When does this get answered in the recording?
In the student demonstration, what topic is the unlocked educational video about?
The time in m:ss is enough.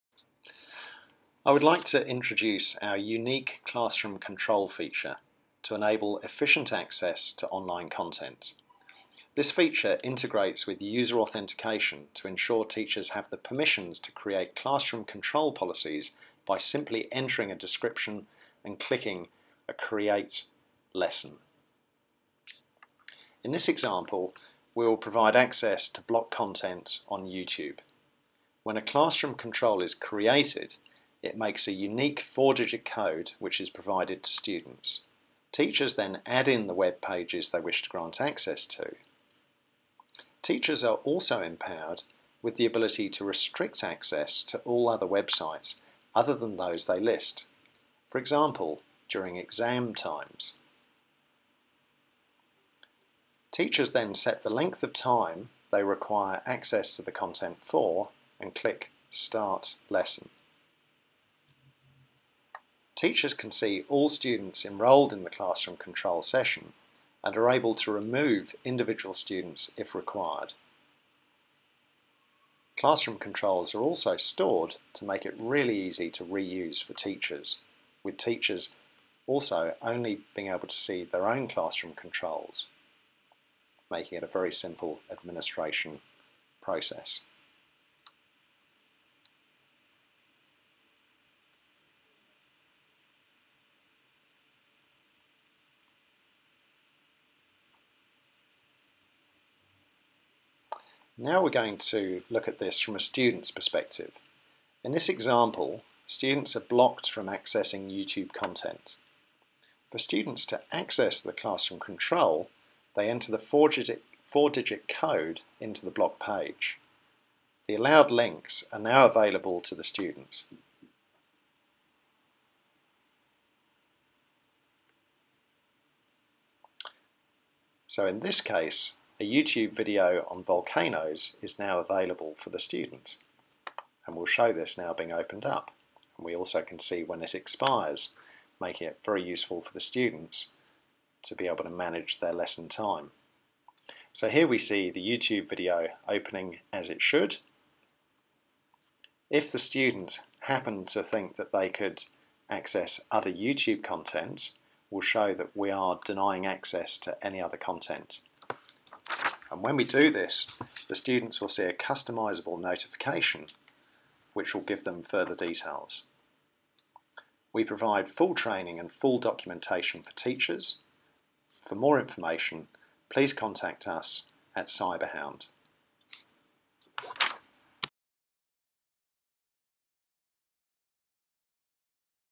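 2:10.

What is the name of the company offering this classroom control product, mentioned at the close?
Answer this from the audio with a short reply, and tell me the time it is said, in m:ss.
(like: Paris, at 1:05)
Cyberhound, at 2:54.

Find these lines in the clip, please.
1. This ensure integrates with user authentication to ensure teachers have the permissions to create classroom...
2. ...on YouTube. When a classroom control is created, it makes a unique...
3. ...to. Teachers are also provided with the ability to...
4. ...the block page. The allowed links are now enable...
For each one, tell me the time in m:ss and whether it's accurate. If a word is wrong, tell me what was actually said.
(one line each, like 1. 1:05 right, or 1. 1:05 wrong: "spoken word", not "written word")
1. 0:09 wrong: "feature", not "ensure"
2. 0:27 right
3. 0:38 wrong: "empowered", not "provided"
4. 1:55 wrong: "available", not "enable".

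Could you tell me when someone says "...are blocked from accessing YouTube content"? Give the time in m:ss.
1:46.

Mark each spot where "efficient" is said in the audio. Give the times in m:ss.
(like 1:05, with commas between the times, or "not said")
0:06.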